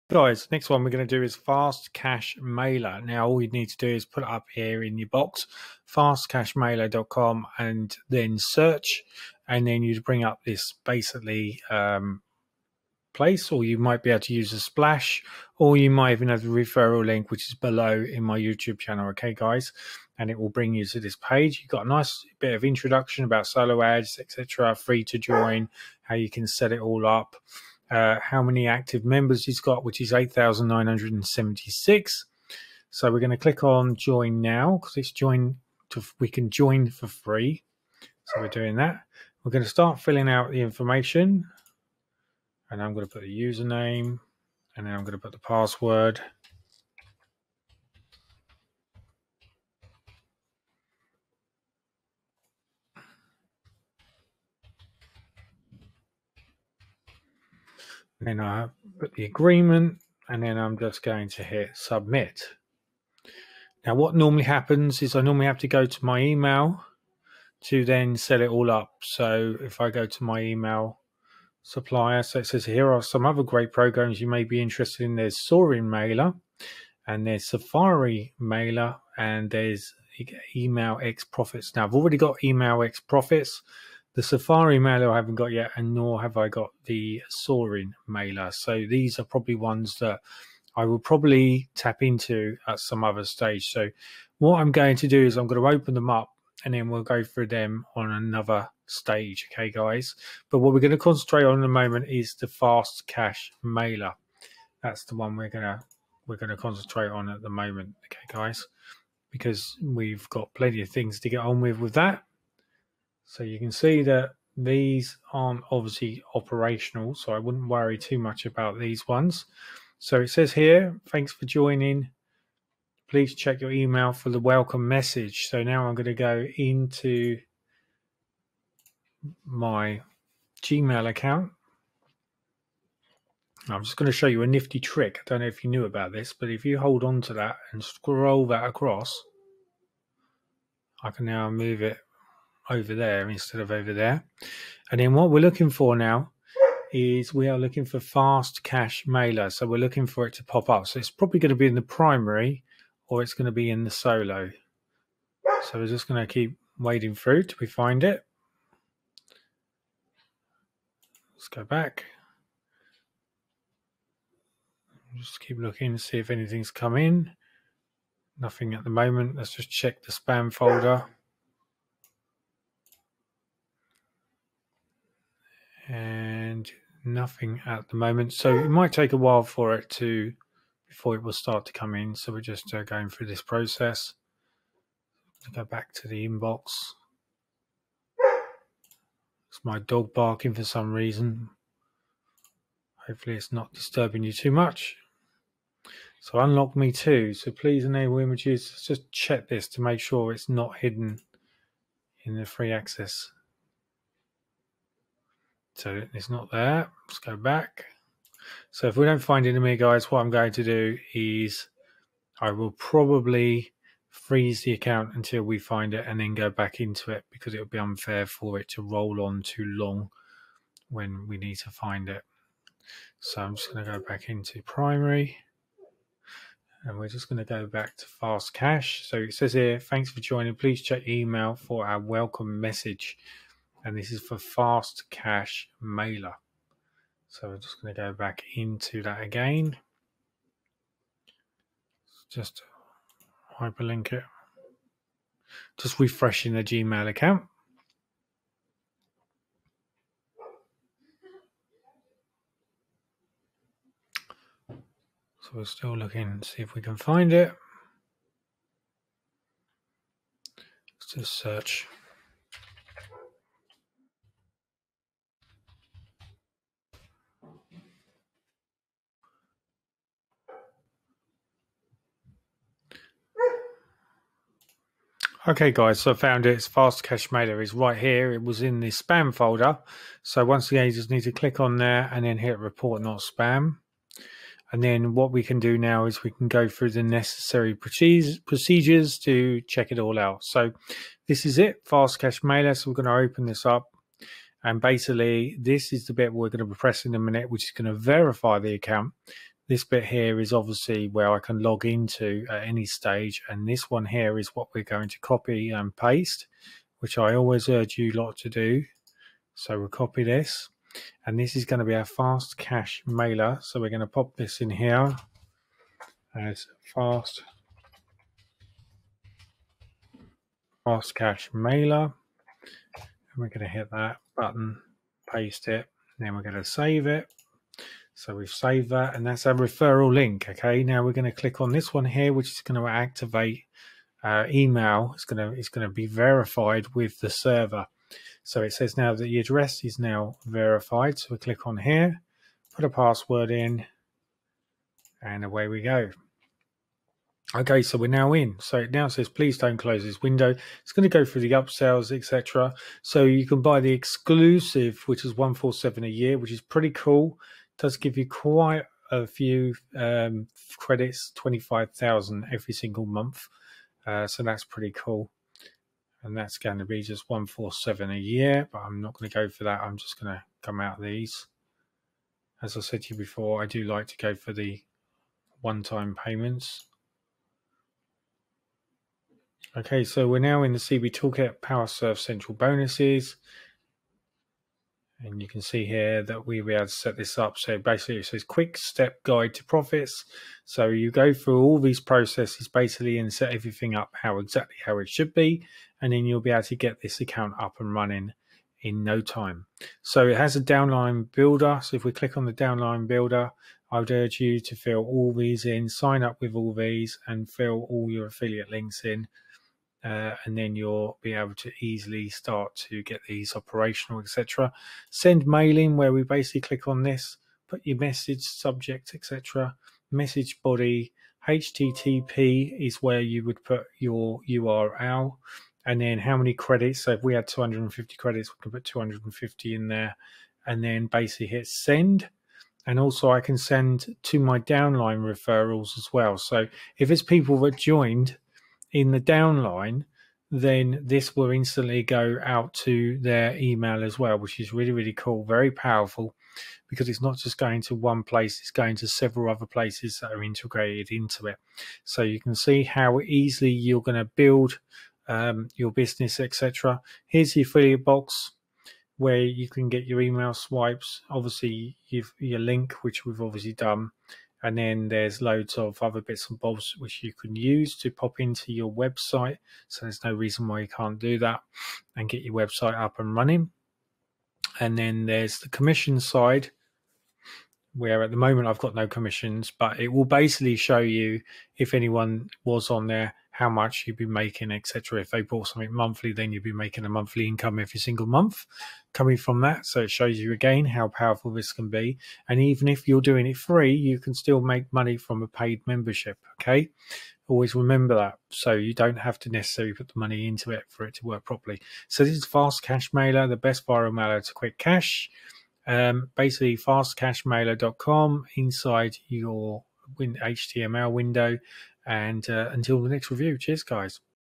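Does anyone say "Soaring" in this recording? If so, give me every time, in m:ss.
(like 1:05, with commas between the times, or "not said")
1:15, 1:27.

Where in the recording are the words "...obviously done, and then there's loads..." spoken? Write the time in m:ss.
7:43.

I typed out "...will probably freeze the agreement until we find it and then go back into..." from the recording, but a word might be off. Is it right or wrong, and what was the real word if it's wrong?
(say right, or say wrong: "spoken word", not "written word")
wrong: "account", not "agreement".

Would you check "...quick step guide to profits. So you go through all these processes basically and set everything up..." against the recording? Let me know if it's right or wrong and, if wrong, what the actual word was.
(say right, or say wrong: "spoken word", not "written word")
right.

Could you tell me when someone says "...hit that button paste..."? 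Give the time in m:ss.
5:23.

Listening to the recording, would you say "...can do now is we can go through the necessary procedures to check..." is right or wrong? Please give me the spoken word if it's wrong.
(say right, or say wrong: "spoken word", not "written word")
right.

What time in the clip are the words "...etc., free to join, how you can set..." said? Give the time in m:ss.
0:24.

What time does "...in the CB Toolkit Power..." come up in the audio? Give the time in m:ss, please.
6:20.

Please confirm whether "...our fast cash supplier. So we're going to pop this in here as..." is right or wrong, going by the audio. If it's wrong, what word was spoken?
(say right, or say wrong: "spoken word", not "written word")
wrong: "mailer", not "supplier".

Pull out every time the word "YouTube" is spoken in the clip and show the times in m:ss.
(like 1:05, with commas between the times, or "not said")
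0:18.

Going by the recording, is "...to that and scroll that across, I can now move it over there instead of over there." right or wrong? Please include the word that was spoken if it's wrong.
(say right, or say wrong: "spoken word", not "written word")
right.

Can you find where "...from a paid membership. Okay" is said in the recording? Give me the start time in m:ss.
8:15.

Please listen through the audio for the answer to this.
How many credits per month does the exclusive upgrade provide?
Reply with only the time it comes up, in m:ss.
6:01.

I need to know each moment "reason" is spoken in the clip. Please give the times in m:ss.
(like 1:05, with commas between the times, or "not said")
3:10, 7:50.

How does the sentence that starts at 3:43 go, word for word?
So I'm just going to go back into primary and we're just going to go back to fast cash.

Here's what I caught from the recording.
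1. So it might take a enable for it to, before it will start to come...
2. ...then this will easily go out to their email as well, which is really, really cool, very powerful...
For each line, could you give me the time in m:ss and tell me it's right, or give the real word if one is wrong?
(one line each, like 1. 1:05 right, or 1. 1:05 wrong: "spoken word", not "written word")
1. 2:58 wrong: "while", not "enable"
2. 7:20 wrong: "instantly", not "easily".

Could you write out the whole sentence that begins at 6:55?
Send mailing where we basically click on this, put your message, subject, etc.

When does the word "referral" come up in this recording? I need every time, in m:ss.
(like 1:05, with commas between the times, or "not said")
0:16, 5:29, 7:15.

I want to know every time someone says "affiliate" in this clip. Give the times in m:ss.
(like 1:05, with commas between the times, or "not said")
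6:48, 7:37.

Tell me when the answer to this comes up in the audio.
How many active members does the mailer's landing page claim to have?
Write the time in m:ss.
0:30.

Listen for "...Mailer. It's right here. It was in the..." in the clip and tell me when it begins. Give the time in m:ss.
4:37.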